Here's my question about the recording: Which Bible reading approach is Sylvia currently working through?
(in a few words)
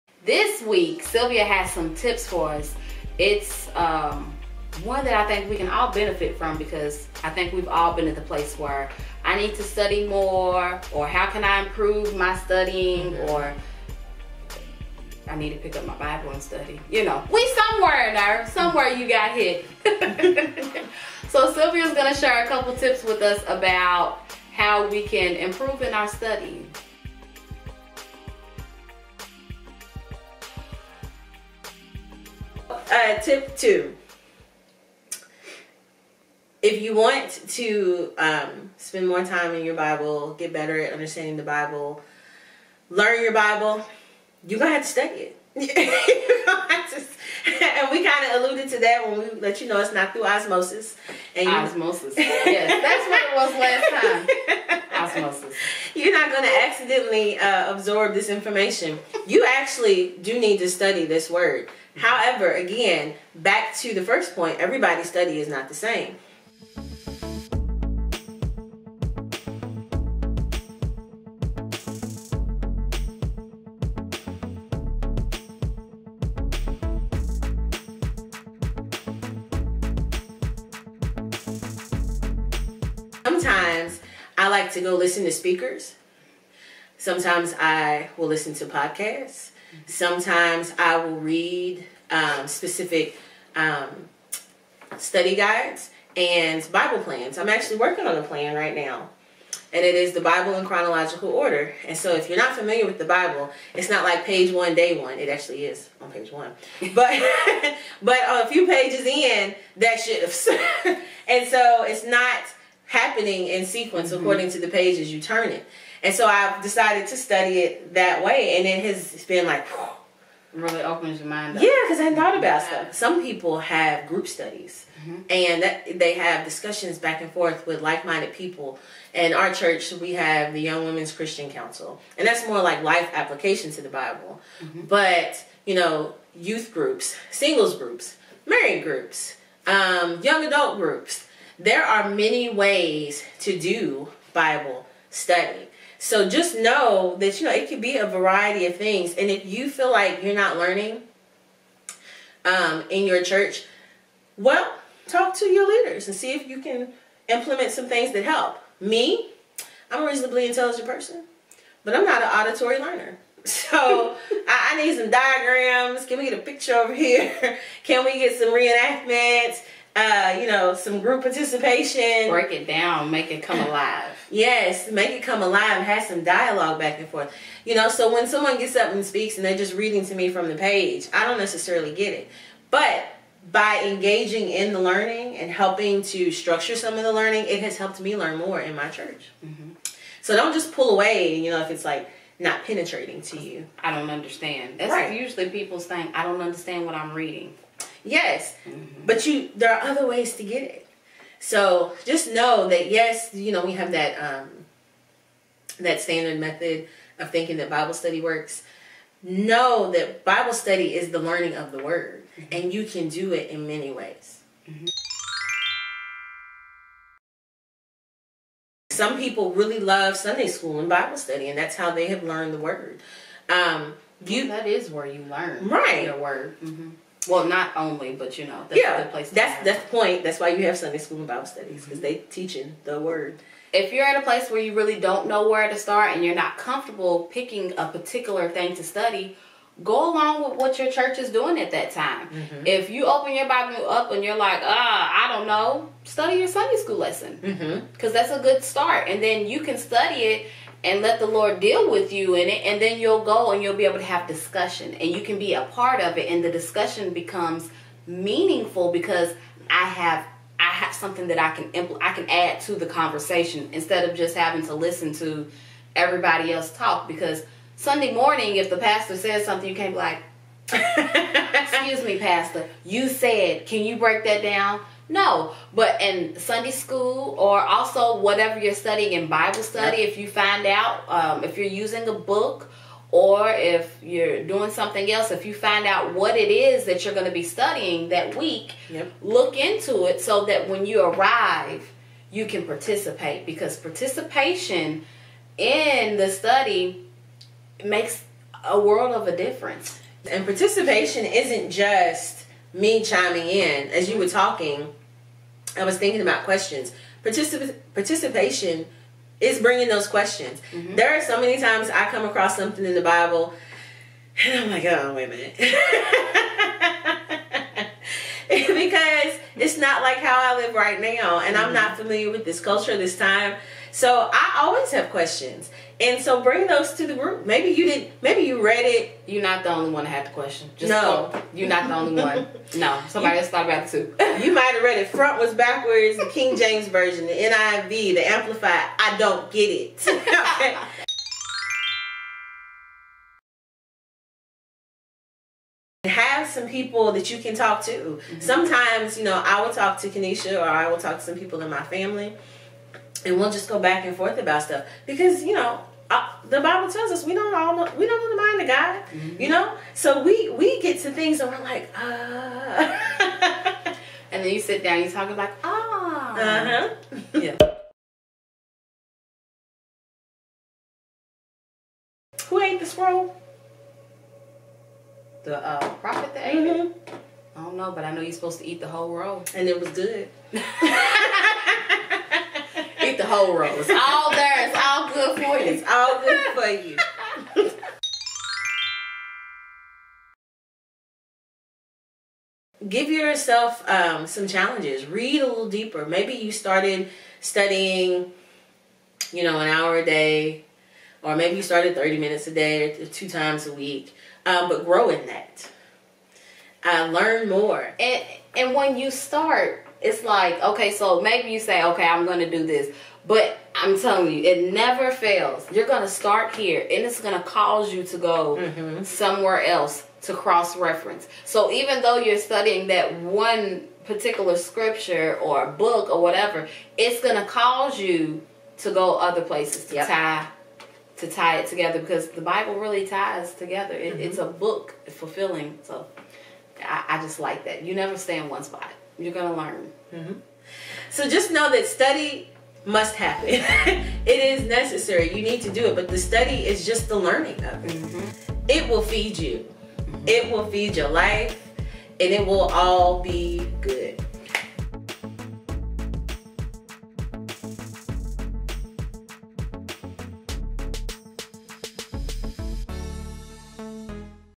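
Chronological order.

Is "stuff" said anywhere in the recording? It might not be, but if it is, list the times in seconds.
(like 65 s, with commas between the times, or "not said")
122 s, 354 s.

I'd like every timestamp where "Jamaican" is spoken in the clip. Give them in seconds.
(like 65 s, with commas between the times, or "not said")
not said.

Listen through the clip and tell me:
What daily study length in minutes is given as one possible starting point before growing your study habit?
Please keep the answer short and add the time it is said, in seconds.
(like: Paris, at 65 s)
30, at 401 s.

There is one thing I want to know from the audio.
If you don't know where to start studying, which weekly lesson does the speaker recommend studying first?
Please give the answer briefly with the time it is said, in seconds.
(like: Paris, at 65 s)
Sunday school lesson, at 246 s.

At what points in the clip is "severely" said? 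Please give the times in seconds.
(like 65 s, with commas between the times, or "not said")
not said.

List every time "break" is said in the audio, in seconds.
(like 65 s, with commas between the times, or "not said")
172 s, 273 s.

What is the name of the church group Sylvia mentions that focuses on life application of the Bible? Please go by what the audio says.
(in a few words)
Young Women's Christian Council.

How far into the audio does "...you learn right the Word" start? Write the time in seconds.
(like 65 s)
225 s.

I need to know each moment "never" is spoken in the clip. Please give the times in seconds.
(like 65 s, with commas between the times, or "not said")
414 s, 437 s.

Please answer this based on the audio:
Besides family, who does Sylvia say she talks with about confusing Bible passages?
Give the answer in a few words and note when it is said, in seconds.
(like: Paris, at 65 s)
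Coneshia, at 350 s.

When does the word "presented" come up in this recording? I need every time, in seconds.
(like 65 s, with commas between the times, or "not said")
not said.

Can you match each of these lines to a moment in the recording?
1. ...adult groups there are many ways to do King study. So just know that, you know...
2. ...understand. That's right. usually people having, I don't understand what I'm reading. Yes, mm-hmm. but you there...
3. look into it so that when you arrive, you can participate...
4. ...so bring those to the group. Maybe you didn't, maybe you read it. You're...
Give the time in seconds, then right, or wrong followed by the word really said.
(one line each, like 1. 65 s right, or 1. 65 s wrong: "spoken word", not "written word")
1. 140 s wrong: "Bible", not "King"
2. 194 s wrong: "saying", not "having"
3. 289 s right
4. 326 s right.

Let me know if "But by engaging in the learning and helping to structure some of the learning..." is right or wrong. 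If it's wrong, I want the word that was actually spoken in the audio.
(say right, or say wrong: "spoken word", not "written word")
right.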